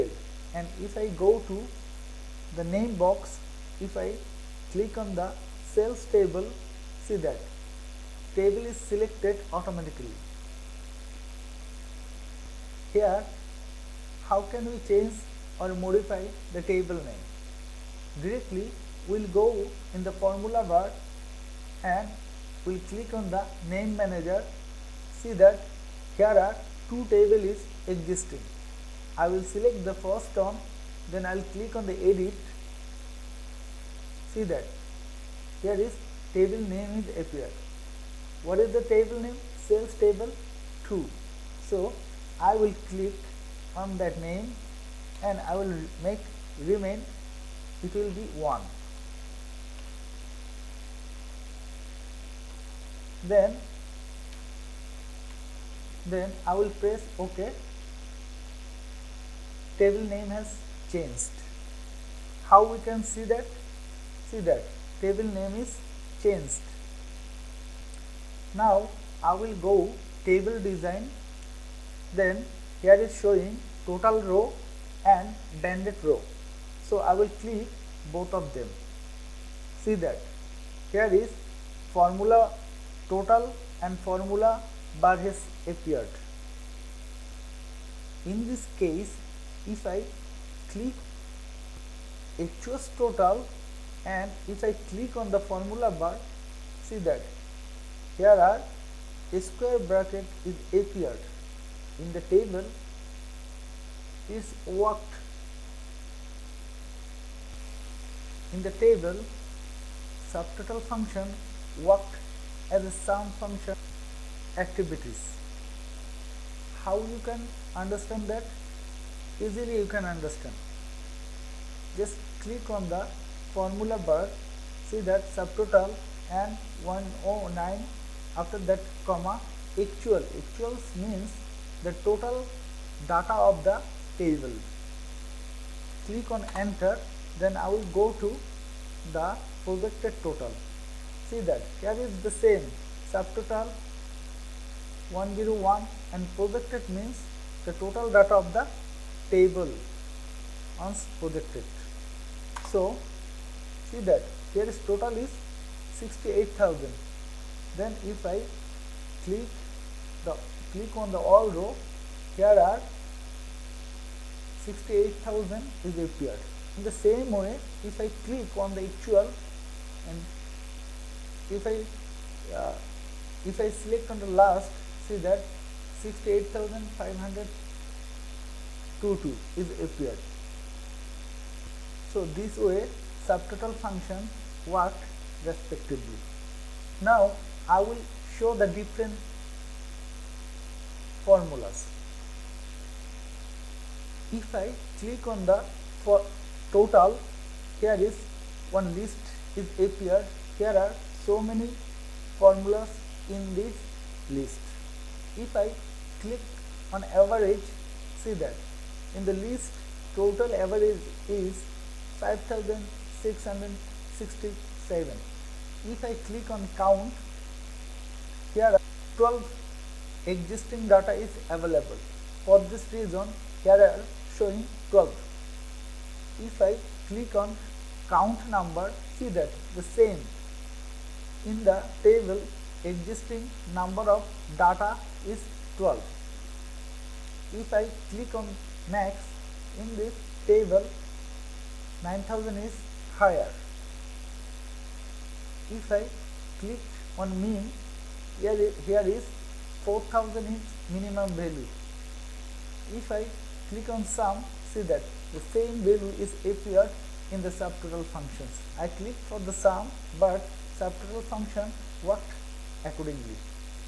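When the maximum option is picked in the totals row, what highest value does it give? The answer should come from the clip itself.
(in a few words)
9000.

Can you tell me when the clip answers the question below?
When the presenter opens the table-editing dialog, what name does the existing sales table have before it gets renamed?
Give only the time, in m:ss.
0:39.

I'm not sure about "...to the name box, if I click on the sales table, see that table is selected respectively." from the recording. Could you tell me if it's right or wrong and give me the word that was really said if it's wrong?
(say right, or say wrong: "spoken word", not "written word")
wrong: "automatically", not "respectively".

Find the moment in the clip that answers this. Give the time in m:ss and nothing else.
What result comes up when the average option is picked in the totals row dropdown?
3:32.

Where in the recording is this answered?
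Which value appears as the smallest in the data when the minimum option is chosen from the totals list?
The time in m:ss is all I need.
4:09.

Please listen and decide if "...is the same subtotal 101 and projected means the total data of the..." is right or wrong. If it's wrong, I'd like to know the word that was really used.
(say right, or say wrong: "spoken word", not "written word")
right.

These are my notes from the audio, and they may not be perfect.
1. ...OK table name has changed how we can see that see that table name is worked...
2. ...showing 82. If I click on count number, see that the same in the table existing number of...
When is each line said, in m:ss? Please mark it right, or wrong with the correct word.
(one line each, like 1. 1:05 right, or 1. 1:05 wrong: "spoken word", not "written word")
1. 0:57 wrong: "changed", not "worked"
2. 3:44 wrong: "12", not "82".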